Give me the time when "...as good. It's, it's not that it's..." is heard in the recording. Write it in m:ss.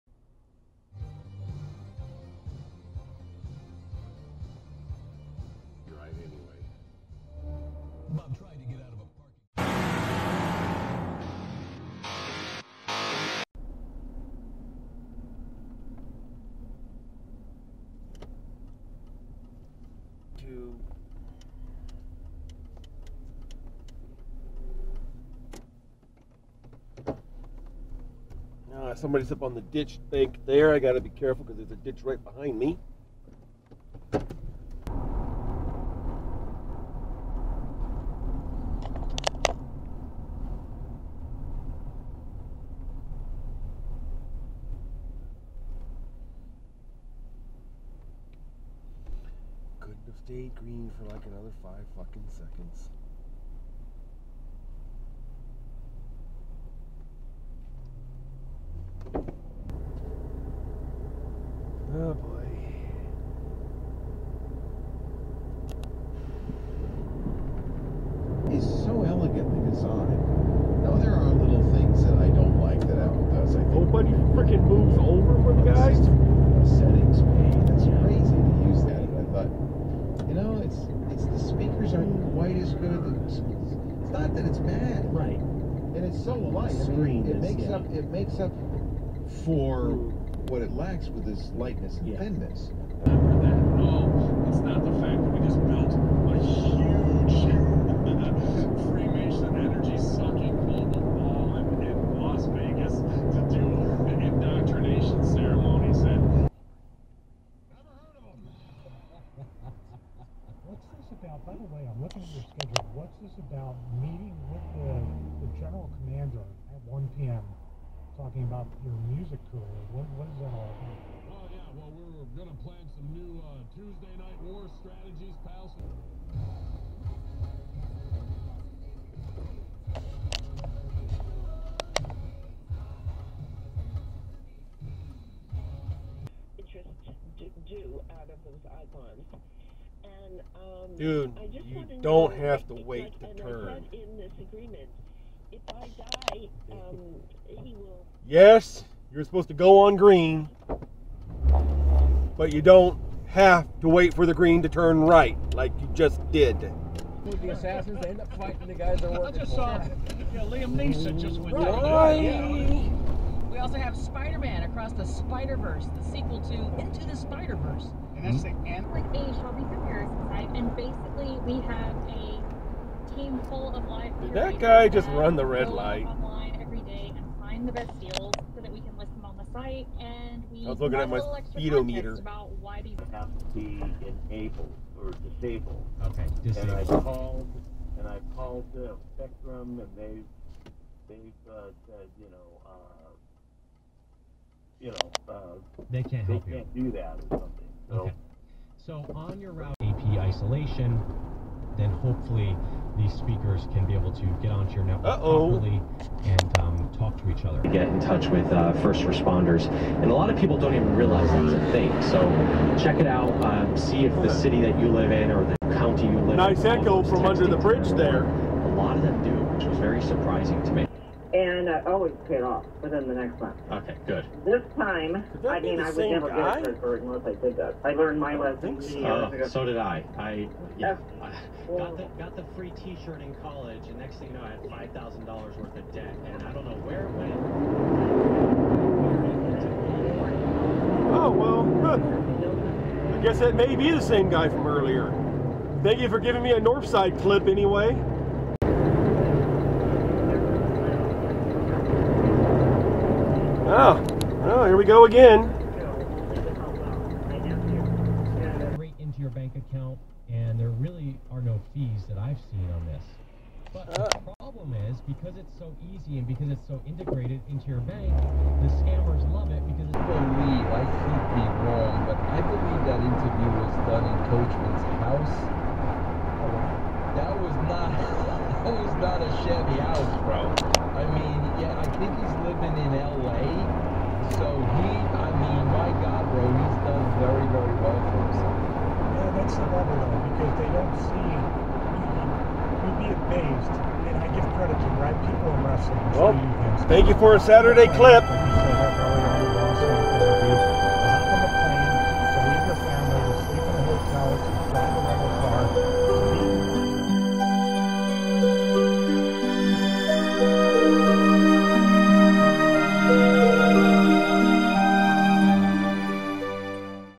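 1:22.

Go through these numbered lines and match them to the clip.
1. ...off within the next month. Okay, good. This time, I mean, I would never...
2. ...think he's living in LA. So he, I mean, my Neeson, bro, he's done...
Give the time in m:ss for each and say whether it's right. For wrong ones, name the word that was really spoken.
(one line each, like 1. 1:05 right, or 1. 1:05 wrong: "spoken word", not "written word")
1. 3:42 right
2. 4:41 wrong: "God", not "Neeson".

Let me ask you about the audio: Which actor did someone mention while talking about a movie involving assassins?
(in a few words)
Liam Neeson.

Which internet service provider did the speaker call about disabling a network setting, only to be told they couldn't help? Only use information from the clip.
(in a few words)
Spectrum.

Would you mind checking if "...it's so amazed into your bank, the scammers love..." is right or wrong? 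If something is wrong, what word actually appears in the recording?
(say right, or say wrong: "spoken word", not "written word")
wrong: "integrated", not "amazed".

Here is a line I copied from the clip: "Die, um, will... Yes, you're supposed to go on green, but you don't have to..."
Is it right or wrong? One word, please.
right.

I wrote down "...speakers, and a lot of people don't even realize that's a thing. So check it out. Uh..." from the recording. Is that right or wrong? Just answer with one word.
wrong.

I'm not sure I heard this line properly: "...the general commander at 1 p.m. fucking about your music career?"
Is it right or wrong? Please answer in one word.
wrong.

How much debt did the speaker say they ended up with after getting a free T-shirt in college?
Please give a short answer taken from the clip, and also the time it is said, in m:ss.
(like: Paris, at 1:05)
$5,000, at 3:54.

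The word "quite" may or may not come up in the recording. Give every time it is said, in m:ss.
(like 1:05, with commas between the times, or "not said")
1:22.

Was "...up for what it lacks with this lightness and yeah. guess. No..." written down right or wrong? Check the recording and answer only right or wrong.
wrong.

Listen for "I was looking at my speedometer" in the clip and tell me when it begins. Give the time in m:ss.
3:00.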